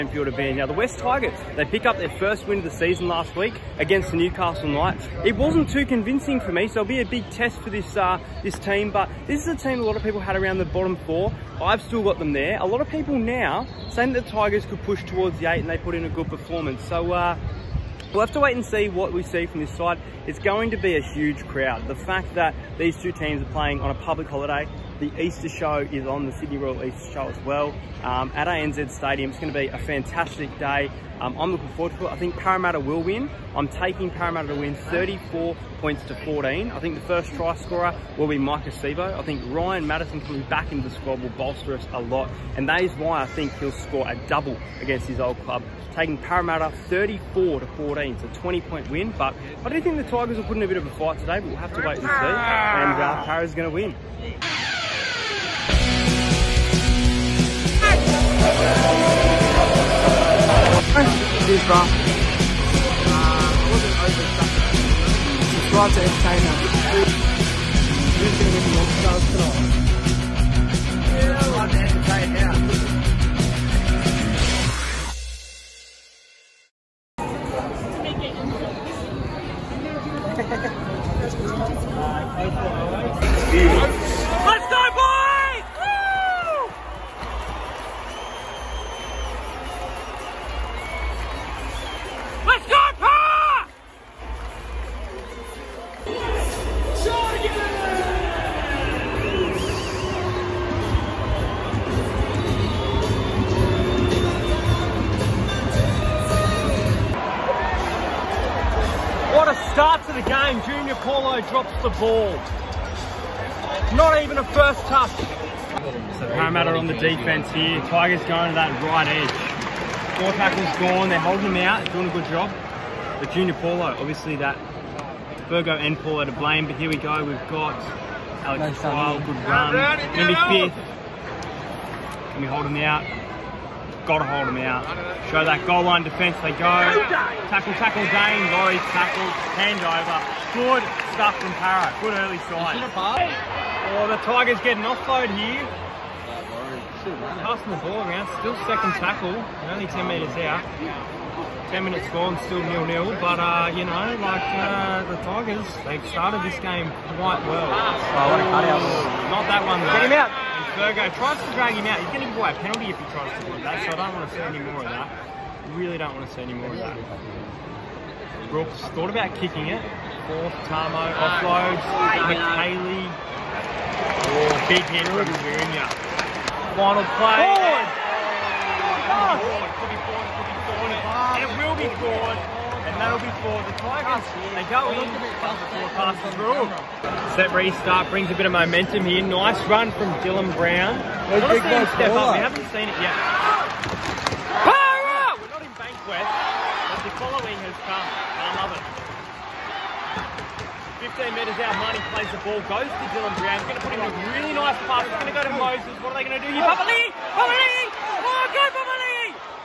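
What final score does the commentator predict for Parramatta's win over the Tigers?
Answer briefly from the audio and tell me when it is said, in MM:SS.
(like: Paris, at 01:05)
34 to 14, at 00:34.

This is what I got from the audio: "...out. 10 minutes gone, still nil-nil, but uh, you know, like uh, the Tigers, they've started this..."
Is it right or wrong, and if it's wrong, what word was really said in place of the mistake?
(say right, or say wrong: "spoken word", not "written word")
right.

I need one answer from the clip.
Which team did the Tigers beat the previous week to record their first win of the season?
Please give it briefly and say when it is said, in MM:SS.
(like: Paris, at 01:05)
Newcastle Knights, at 00:04.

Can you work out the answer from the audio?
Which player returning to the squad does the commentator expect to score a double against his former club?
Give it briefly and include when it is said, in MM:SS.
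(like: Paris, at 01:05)
Ryan Matterson, at 00:39.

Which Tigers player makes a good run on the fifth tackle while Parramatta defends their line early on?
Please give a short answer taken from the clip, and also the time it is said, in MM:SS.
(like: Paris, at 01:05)
Alex Twal, at 02:08.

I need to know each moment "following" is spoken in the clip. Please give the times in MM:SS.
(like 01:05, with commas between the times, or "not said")
03:17.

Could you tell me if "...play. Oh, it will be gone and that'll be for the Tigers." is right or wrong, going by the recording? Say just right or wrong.
right.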